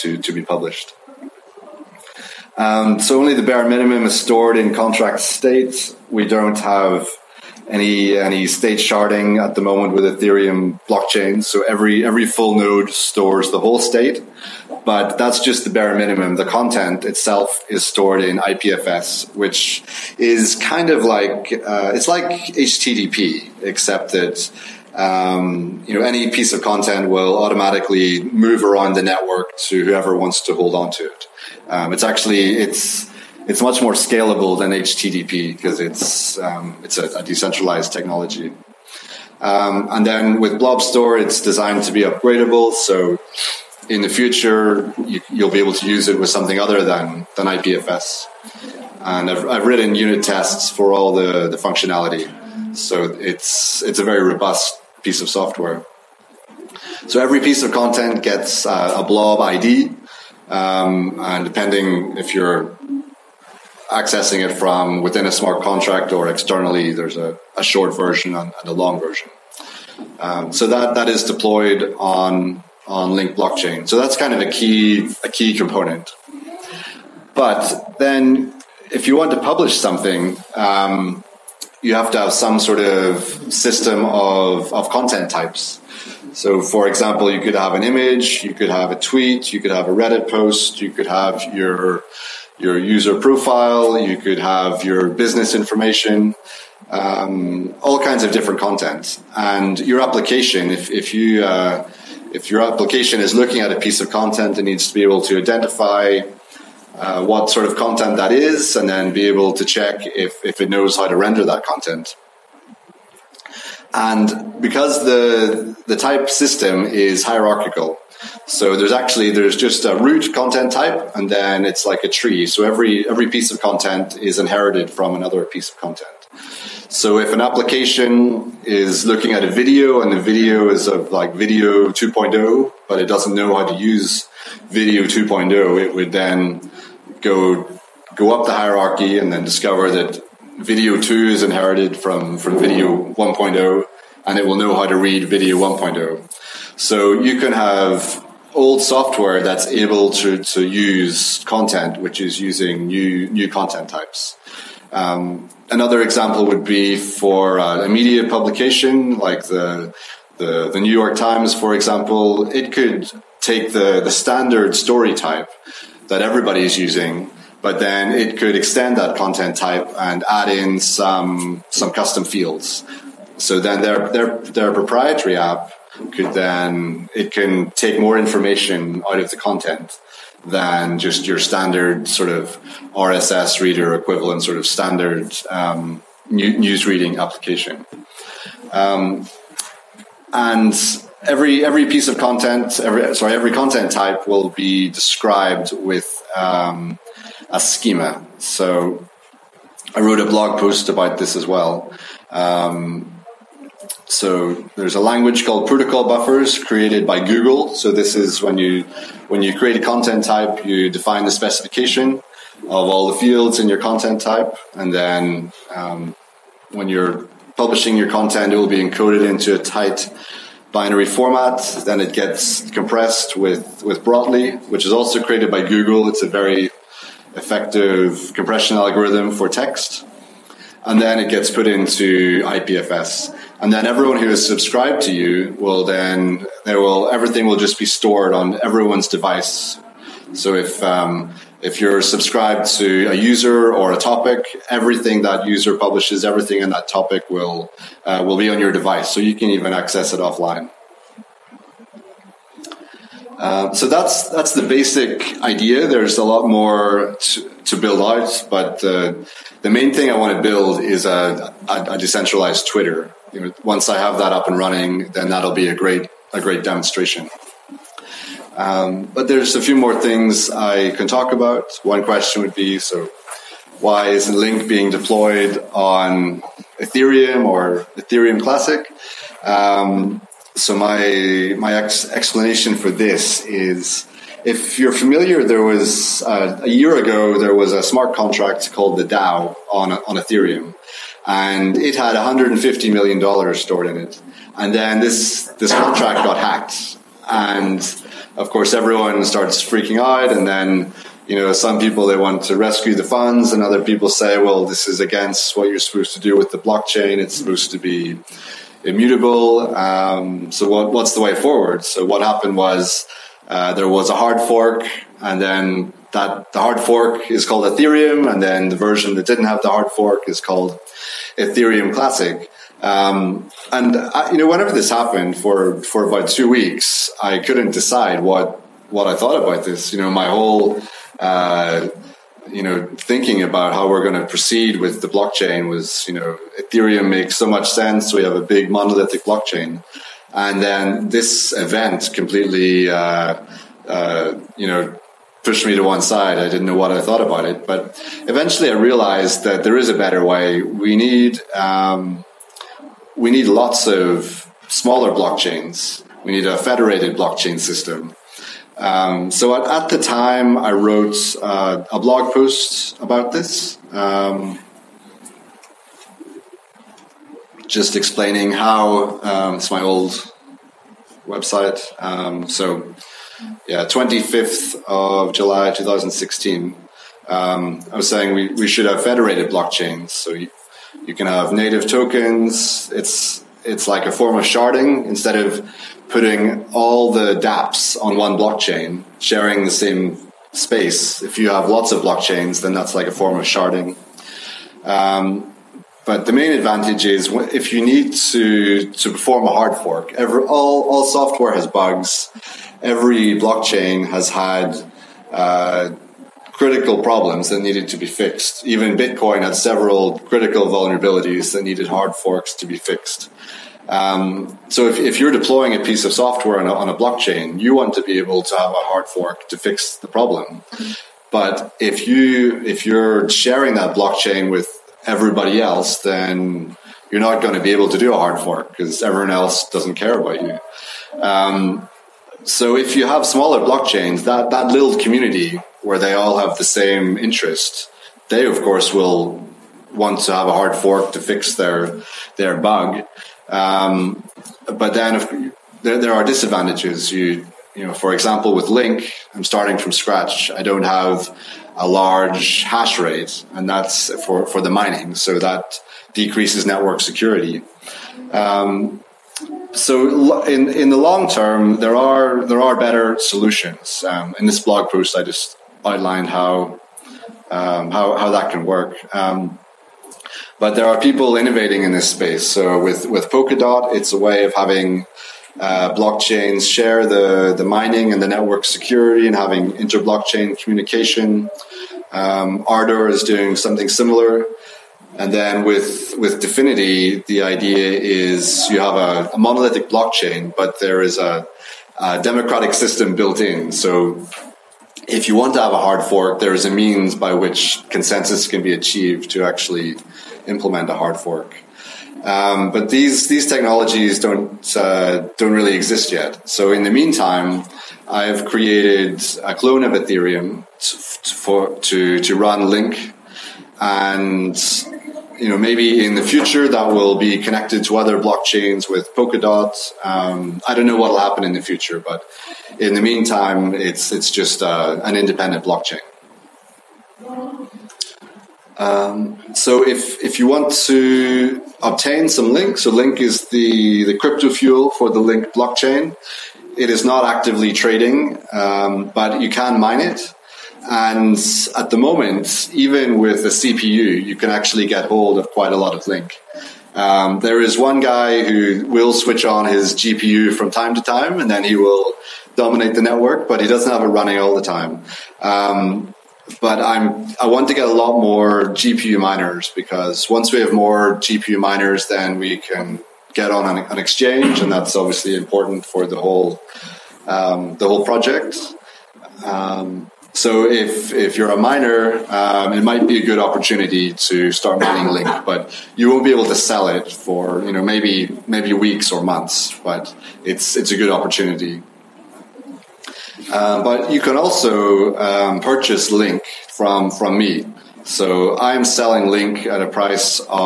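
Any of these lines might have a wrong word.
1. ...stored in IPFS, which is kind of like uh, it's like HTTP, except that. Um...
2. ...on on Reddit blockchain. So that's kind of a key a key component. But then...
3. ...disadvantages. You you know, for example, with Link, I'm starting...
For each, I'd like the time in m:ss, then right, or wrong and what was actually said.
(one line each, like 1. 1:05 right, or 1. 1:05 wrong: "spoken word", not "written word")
1. 0:17 right
2. 1:11 wrong: "Link", not "Reddit"
3. 7:26 right.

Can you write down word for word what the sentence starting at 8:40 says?
Um, I don't know what will happen in the future, but in the meantime, it's it's just uh, an independent blockchain.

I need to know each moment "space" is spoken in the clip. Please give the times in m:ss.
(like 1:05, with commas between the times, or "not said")
6:30, 7:52.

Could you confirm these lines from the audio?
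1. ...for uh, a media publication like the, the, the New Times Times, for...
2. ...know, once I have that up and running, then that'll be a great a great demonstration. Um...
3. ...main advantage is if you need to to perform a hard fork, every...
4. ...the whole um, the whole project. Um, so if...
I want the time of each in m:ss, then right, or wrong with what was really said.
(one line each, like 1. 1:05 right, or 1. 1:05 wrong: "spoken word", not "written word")
1. 2:36 wrong: "York", not "Times"
2. 4:23 right
3. 6:36 right
4. 9:26 right.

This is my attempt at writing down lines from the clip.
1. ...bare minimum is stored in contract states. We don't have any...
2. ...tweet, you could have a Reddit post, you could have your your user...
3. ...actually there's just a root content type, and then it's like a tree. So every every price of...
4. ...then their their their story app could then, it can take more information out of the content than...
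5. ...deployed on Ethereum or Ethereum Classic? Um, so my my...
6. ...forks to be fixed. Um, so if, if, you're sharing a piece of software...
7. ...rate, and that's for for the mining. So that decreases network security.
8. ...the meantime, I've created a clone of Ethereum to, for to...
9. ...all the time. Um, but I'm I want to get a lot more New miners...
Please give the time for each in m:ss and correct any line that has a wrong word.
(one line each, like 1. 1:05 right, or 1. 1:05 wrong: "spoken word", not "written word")
1. 0:03 right
2. 1:28 right
3. 1:58 wrong: "piece", not "price"
4. 2:53 wrong: "proprietary", not "story"
5. 4:34 right
6. 6:52 wrong: "deploying", not "sharing"
7. 7:32 right
8. 8:26 right
9. 9:14 wrong: "GPU", not "New".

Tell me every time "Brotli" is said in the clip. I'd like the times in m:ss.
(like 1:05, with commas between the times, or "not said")
3:44.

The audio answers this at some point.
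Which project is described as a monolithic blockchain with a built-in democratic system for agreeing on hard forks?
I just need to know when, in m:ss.
8:06.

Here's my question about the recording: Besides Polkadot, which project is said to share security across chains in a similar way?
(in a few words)
Ardor.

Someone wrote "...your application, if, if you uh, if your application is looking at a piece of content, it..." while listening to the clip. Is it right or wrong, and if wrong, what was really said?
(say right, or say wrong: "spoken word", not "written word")
right.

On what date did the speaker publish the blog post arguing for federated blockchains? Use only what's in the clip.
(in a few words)
25 July 2016.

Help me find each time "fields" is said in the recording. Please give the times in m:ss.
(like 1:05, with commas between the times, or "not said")
2:52, 3:33.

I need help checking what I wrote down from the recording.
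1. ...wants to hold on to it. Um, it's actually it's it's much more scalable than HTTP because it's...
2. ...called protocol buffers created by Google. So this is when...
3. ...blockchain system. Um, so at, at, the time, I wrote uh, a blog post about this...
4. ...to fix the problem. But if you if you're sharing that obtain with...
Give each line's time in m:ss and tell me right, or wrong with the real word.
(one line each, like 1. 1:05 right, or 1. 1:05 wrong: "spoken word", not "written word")
1. 0:30 right
2. 3:25 right
3. 5:57 right
4. 6:59 wrong: "blockchain", not "obtain".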